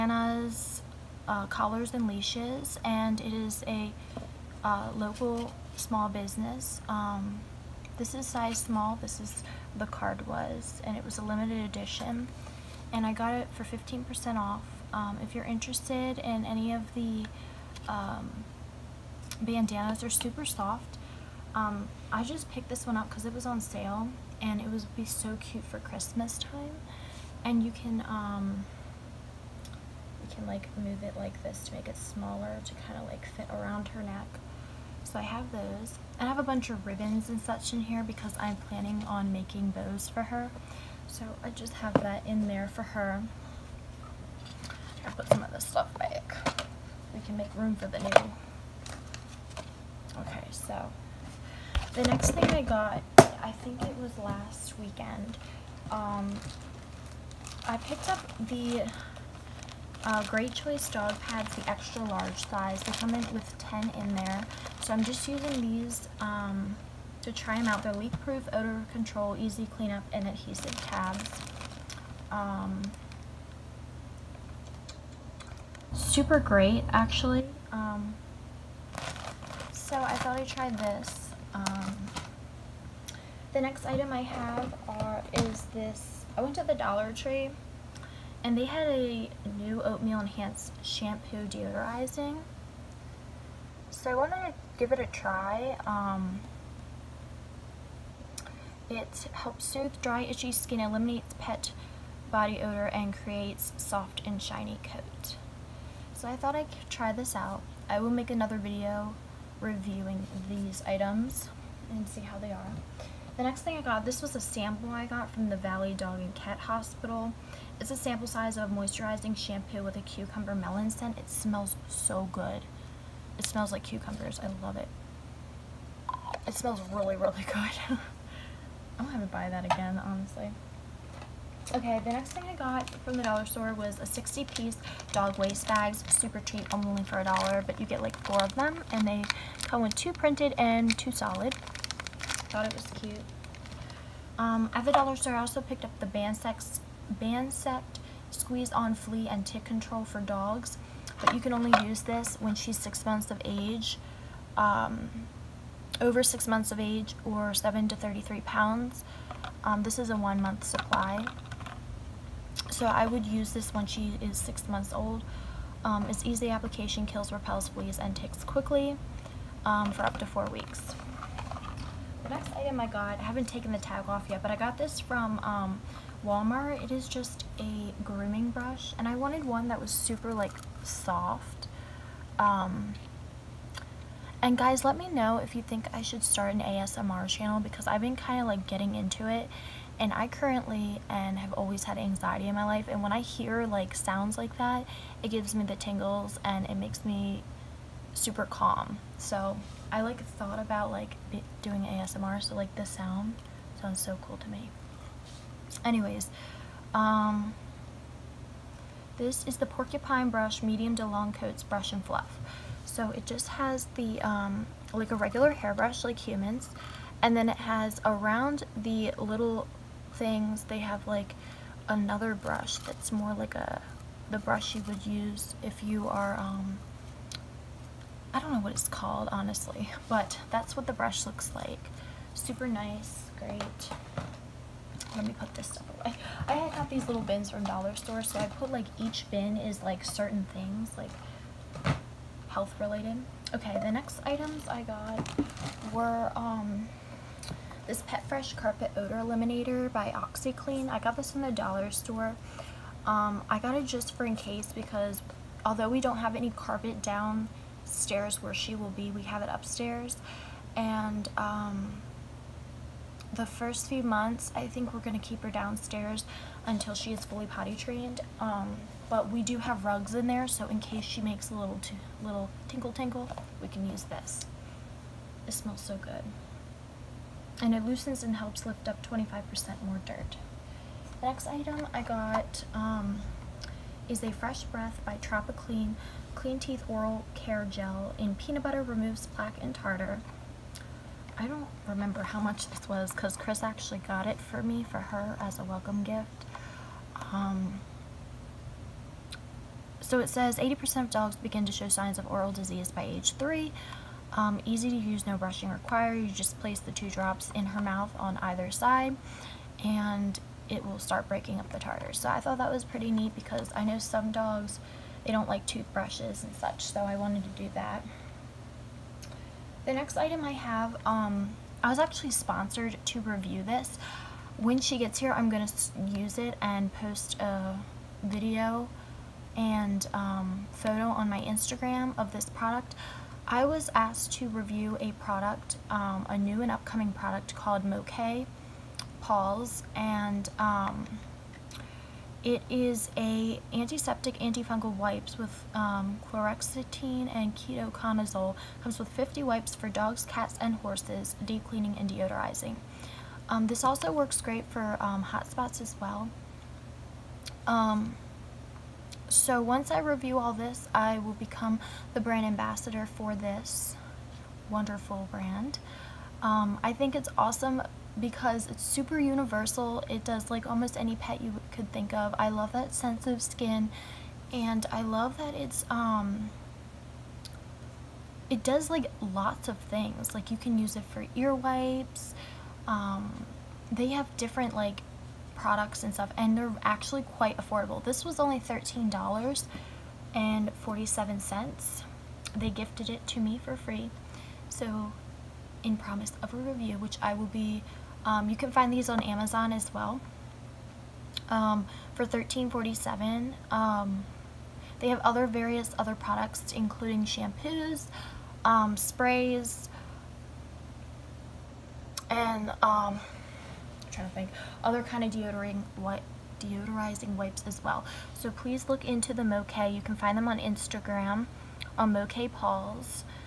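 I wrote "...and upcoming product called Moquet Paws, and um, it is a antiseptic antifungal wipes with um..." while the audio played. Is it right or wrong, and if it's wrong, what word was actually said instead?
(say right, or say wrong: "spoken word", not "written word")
right.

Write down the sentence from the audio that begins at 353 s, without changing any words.
Um, this also works great for um, hot spots as well.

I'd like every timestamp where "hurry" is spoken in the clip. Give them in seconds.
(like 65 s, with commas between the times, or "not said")
not said.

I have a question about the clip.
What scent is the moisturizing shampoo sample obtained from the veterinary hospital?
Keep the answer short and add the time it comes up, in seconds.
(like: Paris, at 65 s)
cucumber melon, at 120 s.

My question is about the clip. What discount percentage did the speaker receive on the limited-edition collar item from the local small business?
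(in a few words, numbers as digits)
15%.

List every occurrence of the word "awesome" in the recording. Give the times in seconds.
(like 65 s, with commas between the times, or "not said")
367 s.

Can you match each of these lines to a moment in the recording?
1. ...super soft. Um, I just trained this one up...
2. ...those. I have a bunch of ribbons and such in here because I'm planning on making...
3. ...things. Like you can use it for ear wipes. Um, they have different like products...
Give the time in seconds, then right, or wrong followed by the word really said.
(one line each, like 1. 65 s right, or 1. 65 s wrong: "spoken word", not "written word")
1. 20 s wrong: "picked", not "trained"
2. 35 s right
3. 379 s right.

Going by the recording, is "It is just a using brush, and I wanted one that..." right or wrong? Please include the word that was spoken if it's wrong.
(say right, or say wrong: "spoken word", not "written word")
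wrong: "grooming", not "using".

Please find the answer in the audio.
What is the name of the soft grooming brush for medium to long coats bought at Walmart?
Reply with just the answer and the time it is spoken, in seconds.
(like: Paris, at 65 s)
porcupine brush, at 209 s.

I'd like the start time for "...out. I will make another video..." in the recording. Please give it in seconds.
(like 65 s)
107 s.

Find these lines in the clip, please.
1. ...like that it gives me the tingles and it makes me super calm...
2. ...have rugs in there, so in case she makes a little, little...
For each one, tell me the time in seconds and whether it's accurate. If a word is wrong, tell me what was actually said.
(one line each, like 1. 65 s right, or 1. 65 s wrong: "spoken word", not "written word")
1. 194 s right
2. 269 s right.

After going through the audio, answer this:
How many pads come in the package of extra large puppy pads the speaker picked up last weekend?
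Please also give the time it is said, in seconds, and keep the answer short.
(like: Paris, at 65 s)
10, at 63 s.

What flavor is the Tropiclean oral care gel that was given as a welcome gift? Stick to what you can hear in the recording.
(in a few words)
peanut butter.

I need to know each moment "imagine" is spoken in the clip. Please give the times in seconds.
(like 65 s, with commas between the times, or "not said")
not said.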